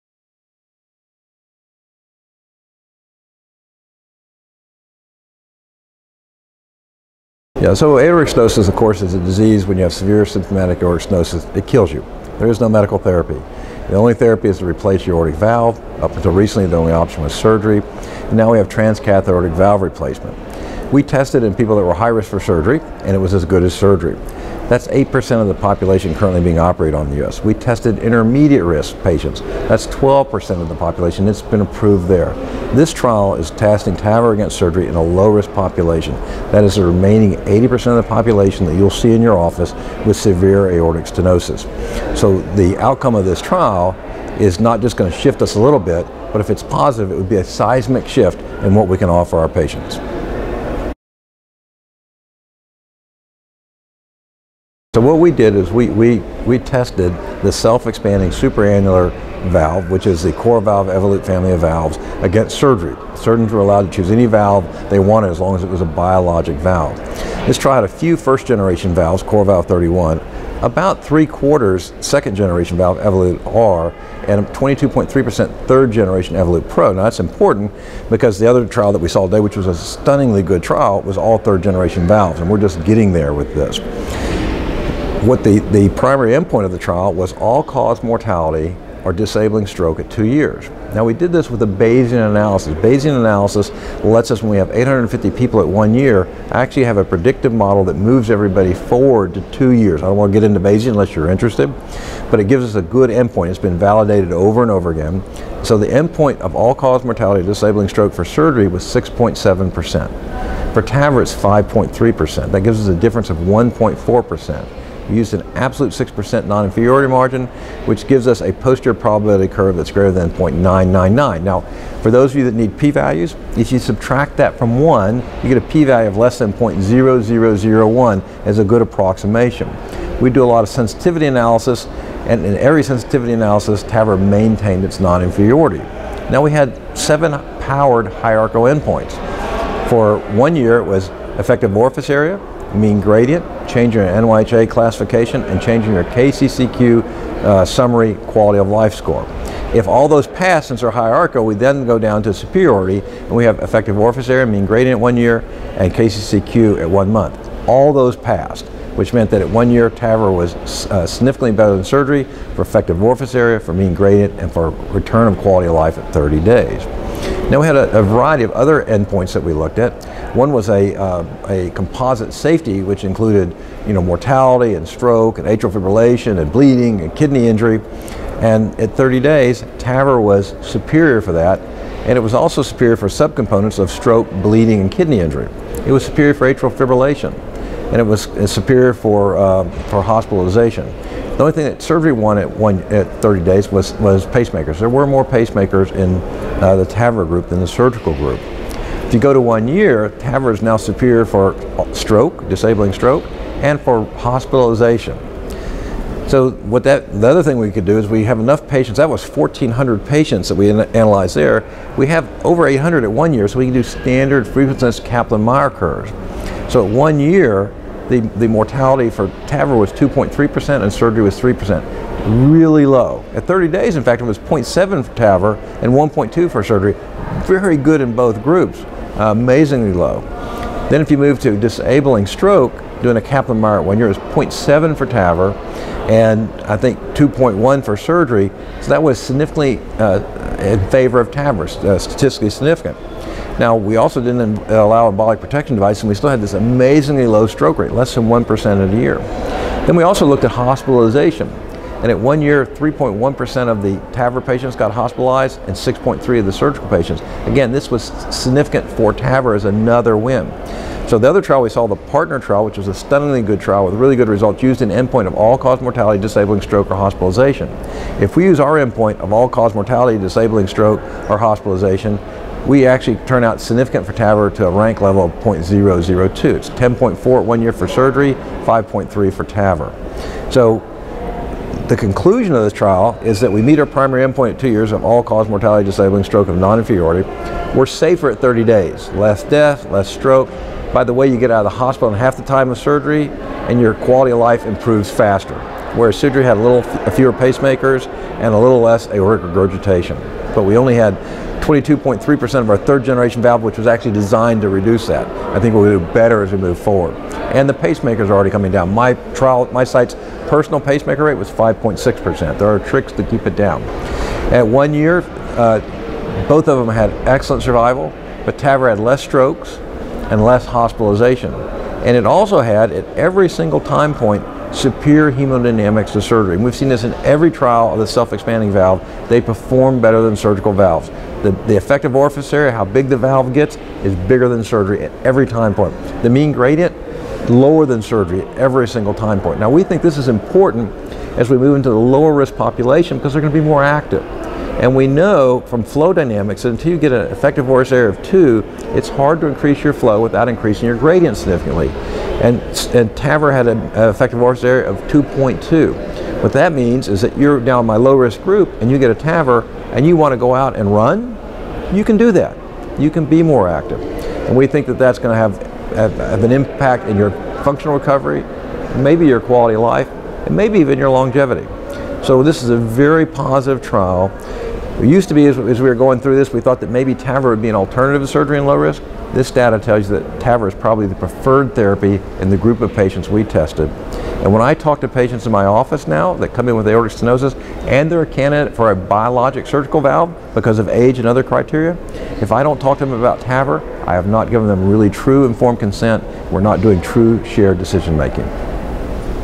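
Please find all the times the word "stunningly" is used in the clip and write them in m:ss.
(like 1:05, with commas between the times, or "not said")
1:19, 4:22.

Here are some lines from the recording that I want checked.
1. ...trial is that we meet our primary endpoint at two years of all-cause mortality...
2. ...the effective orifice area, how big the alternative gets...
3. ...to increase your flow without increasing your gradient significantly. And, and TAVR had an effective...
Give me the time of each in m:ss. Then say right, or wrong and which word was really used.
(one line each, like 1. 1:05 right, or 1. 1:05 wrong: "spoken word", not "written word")
1. 4:42 right
2. 5:31 wrong: "valve", not "alternative"
3. 5:49 right.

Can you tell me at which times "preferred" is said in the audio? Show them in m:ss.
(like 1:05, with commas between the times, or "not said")
6:21.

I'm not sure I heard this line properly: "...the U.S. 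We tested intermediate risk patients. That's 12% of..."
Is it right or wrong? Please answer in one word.
right.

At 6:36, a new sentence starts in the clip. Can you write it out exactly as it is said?
We're not doing true shared decision making.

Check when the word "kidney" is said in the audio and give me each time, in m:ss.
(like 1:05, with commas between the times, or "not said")
2:57, 3:04.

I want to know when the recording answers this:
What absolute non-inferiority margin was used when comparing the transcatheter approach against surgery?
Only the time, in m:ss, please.
1:55.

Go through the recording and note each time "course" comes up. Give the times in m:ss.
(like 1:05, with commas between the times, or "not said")
0:08.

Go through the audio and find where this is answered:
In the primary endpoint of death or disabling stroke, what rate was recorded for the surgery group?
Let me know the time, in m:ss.
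1:48.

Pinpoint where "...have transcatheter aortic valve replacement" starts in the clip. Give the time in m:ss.
0:18.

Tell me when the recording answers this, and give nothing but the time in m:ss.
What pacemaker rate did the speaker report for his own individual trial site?
5:11.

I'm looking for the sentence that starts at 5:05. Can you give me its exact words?
I think we'll do better as we move forward.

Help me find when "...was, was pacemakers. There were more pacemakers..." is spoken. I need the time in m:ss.
3:13.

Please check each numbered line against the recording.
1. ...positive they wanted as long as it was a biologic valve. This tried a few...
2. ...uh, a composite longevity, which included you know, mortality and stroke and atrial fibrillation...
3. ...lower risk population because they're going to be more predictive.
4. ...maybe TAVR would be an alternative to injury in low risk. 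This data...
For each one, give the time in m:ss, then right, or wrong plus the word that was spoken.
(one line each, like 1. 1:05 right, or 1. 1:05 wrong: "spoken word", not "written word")
1. 1:04 wrong: "valve", not "positive"
2. 2:50 wrong: "safety", not "longevity"
3. 5:41 wrong: "active", not "predictive"
4. 6:16 wrong: "surgery", not "injury".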